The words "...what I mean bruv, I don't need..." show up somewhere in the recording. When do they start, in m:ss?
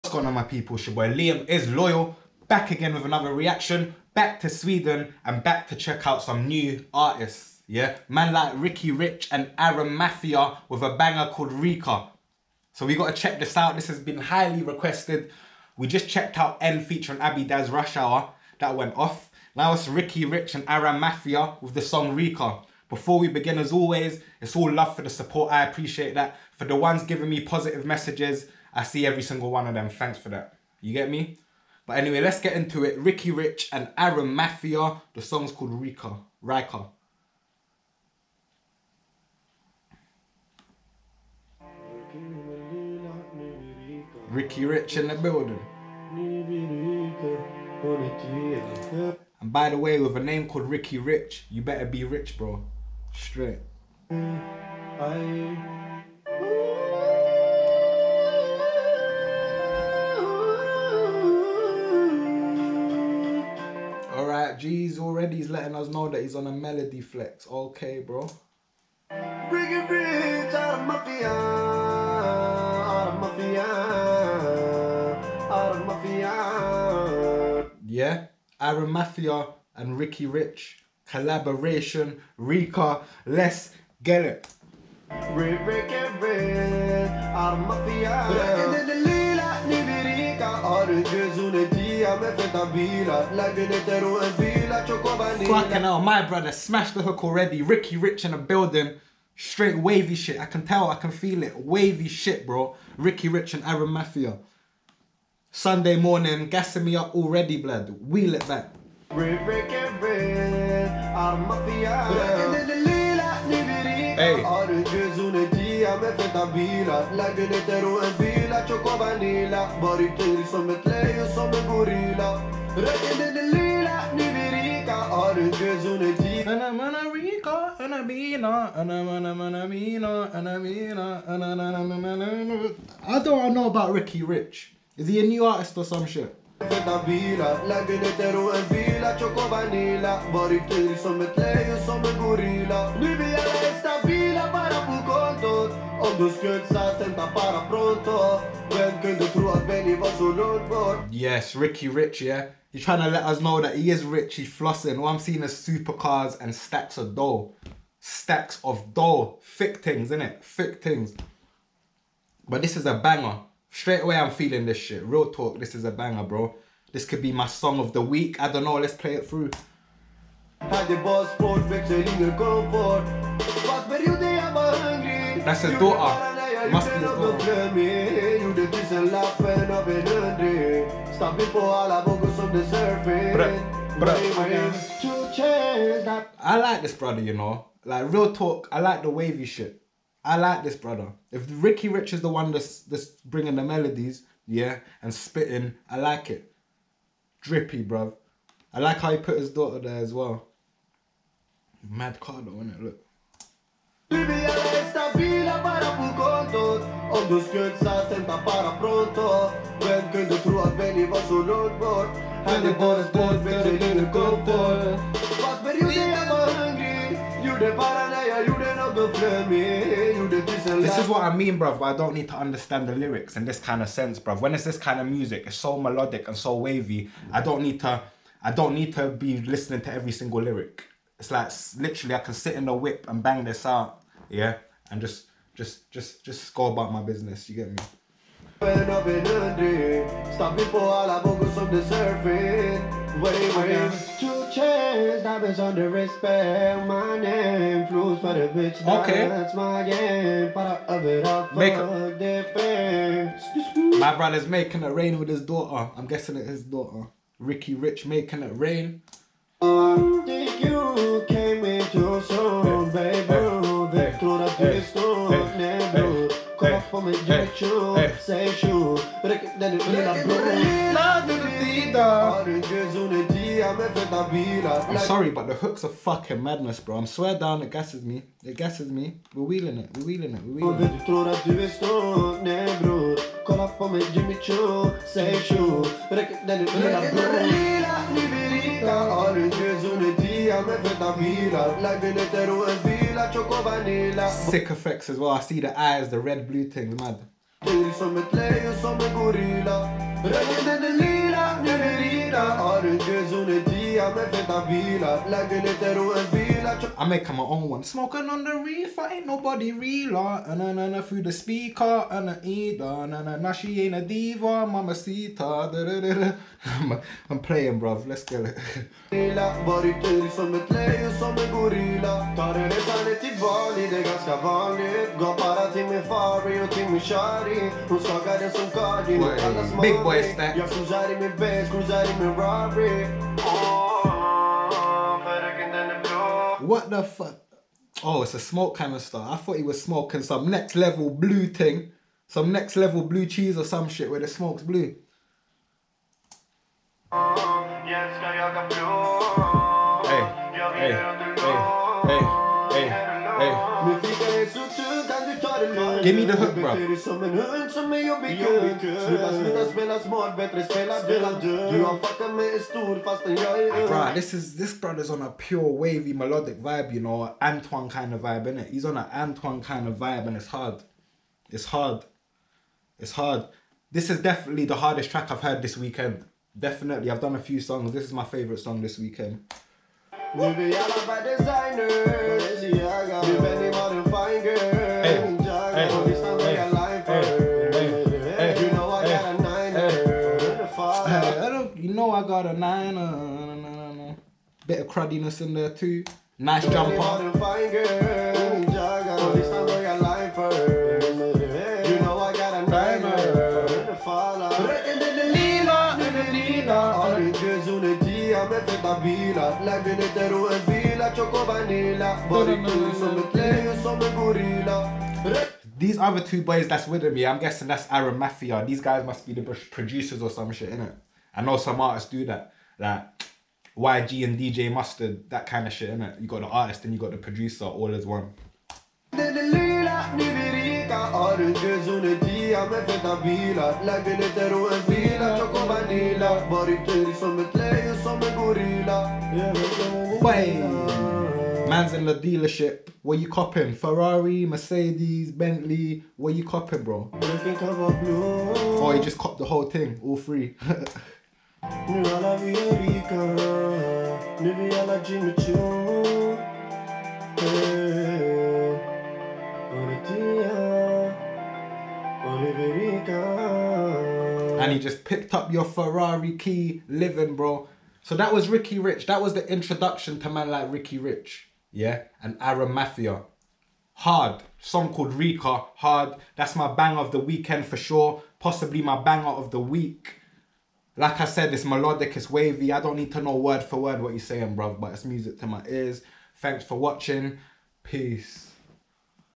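3:41.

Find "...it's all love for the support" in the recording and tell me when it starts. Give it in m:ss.
0:24.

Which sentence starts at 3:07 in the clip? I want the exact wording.
Like real talk, I like the wavy shit.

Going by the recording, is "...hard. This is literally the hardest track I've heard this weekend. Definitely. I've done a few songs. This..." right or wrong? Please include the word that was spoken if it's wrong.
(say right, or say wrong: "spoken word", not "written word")
wrong: "definitely", not "literally".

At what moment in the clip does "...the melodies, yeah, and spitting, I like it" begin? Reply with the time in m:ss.
3:13.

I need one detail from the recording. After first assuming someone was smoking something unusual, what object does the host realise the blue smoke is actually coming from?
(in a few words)
A smoke canister.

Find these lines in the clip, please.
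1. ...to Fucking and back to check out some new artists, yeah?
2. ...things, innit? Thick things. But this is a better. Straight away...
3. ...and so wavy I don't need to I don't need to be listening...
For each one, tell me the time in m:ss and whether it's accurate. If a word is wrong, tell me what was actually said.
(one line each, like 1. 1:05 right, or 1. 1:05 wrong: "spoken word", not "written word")
1. 0:04 wrong: "Sweden", not "Fucking"
2. 2:39 wrong: "banger", not "better"
3. 3:46 right.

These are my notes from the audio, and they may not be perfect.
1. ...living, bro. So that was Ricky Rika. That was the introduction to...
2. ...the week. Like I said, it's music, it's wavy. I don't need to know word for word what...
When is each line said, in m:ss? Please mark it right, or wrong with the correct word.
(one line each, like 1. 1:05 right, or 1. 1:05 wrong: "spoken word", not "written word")
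1. 7:46 wrong: "Rich", not "Rika"
2. 7:59 wrong: "melodic", not "music".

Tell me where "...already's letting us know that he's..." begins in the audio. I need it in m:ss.
1:04.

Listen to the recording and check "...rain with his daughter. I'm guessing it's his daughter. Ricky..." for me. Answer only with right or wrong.
right.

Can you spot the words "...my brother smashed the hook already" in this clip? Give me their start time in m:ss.
1:36.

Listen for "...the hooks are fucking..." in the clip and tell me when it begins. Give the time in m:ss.
4:35.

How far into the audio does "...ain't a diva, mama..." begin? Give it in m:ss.
5:13.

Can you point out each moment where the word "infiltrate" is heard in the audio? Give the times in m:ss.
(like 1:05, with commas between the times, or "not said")
not said.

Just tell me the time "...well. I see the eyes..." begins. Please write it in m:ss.
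4:55.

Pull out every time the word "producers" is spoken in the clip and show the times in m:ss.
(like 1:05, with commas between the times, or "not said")
6:59, 7:07.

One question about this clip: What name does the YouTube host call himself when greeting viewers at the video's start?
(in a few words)
Liam is Loyal.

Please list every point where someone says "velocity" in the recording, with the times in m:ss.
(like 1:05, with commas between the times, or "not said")
not said.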